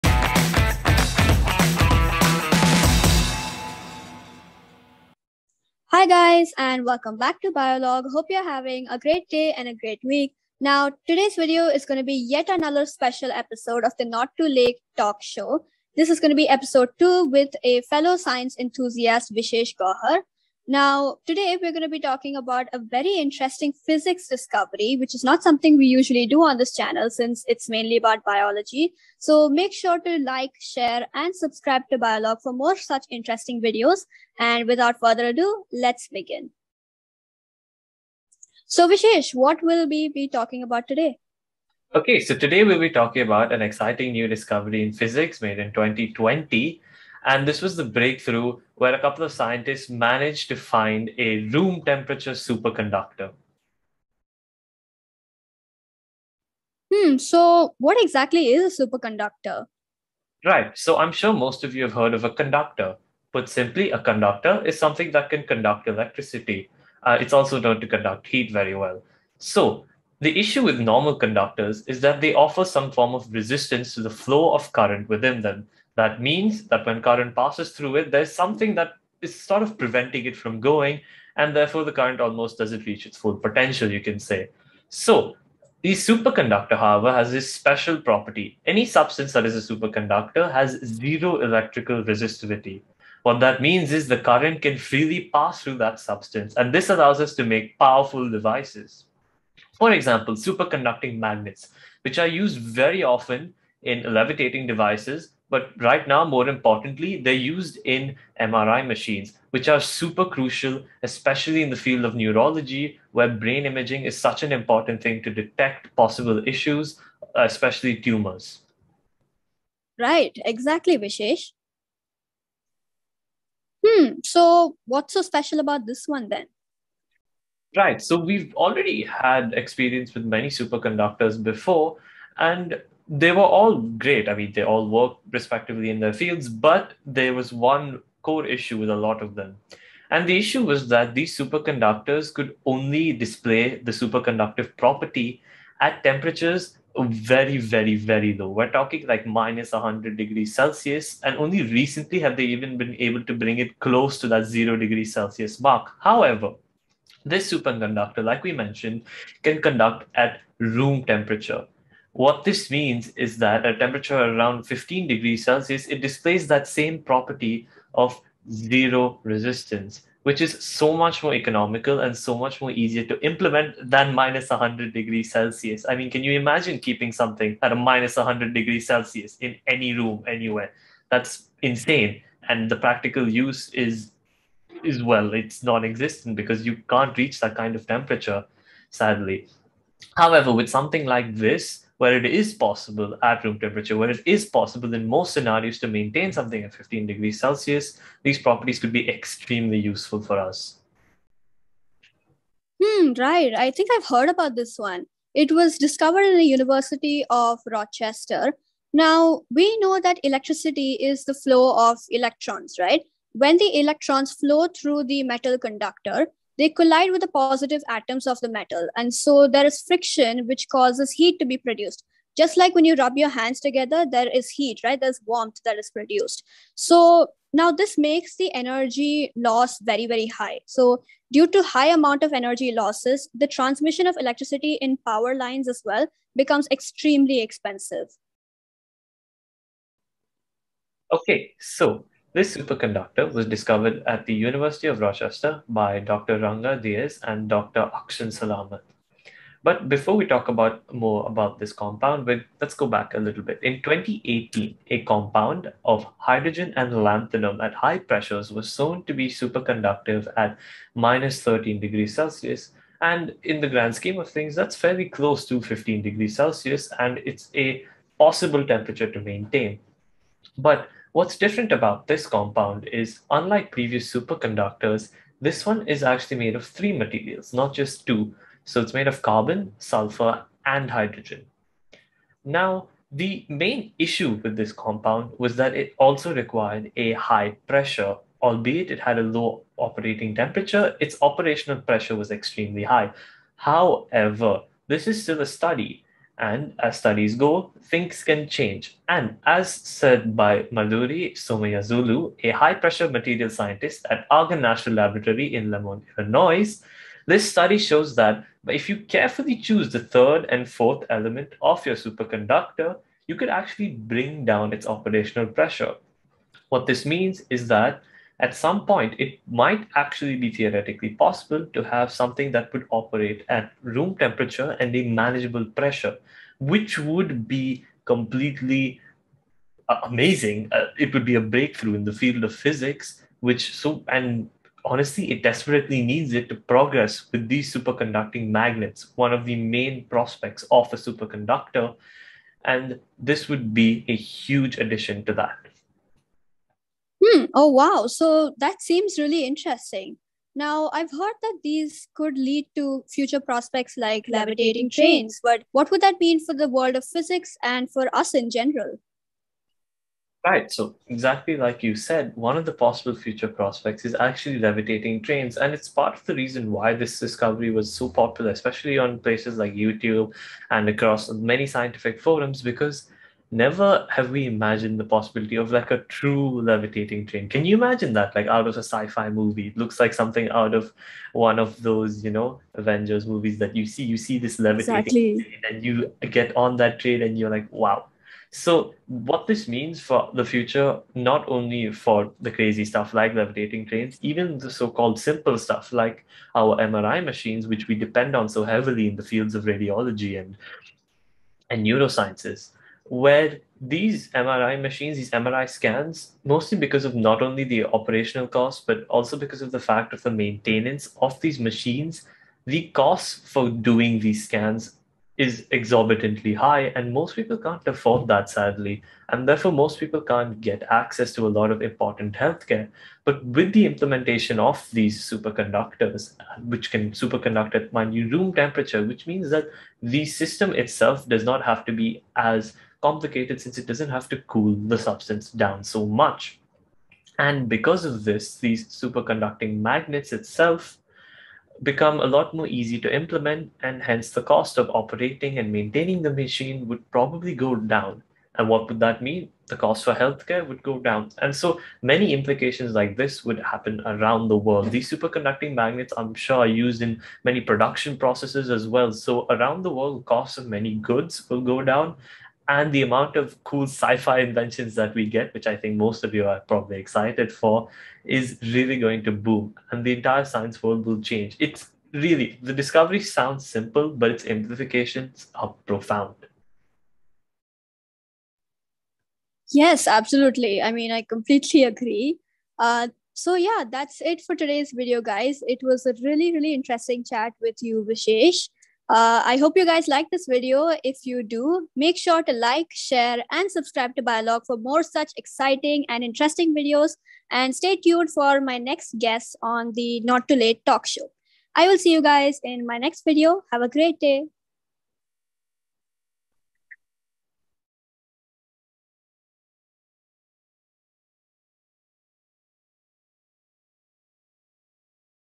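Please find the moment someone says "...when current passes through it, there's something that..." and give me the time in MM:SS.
01:16.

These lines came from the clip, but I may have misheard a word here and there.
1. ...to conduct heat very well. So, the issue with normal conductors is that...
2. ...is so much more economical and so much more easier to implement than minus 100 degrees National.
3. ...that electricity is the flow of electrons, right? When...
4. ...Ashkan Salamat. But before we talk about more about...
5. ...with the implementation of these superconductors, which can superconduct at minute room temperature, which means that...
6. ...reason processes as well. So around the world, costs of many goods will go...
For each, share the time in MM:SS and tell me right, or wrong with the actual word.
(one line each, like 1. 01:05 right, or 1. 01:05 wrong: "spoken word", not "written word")
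1. 01:07 right
2. 02:50 wrong: "Celsius", not "National"
3. 03:29 right
4. 04:07 right
5. 07:03 right
6. 07:37 wrong: "production", not "reason".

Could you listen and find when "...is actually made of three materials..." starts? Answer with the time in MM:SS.
04:35.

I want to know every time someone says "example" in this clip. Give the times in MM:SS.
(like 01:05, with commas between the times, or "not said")
01:39.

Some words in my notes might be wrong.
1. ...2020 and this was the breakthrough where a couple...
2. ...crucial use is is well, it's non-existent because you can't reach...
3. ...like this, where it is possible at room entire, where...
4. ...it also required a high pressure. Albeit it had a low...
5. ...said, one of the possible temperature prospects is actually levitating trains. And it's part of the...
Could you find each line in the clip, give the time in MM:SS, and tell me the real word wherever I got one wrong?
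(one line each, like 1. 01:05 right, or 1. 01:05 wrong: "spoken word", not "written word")
1. 00:45 right
2. 03:02 wrong: "practical", not "crucial"
3. 03:11 wrong: "temperature", not "entire"
4. 04:45 right
5. 06:01 wrong: "future", not "temperature".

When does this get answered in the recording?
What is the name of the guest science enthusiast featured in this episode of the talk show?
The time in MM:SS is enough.
00:19.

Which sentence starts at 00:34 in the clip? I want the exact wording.
And without further ado, let's begin.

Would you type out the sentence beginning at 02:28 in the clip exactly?
We're talking like minus 100 degrees Celsius.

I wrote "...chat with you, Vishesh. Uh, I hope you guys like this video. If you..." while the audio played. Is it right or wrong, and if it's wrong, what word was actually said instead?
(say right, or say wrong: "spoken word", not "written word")
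right.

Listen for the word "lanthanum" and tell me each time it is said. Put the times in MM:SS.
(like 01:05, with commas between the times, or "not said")
04:17.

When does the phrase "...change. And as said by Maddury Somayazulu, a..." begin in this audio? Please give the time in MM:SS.
04:58.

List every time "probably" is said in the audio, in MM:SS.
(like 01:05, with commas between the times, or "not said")
07:27, 07:46.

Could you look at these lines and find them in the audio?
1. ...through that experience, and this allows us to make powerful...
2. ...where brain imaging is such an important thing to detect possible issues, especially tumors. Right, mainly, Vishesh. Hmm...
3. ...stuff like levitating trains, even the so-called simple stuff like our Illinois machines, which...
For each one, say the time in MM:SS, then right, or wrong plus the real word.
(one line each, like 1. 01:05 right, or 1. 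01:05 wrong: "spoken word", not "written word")
1. 01:35 wrong: "substance", not "experience"
2. 01:53 wrong: "exactly", not "mainly"
3. 06:32 wrong: "MRI", not "Illinois".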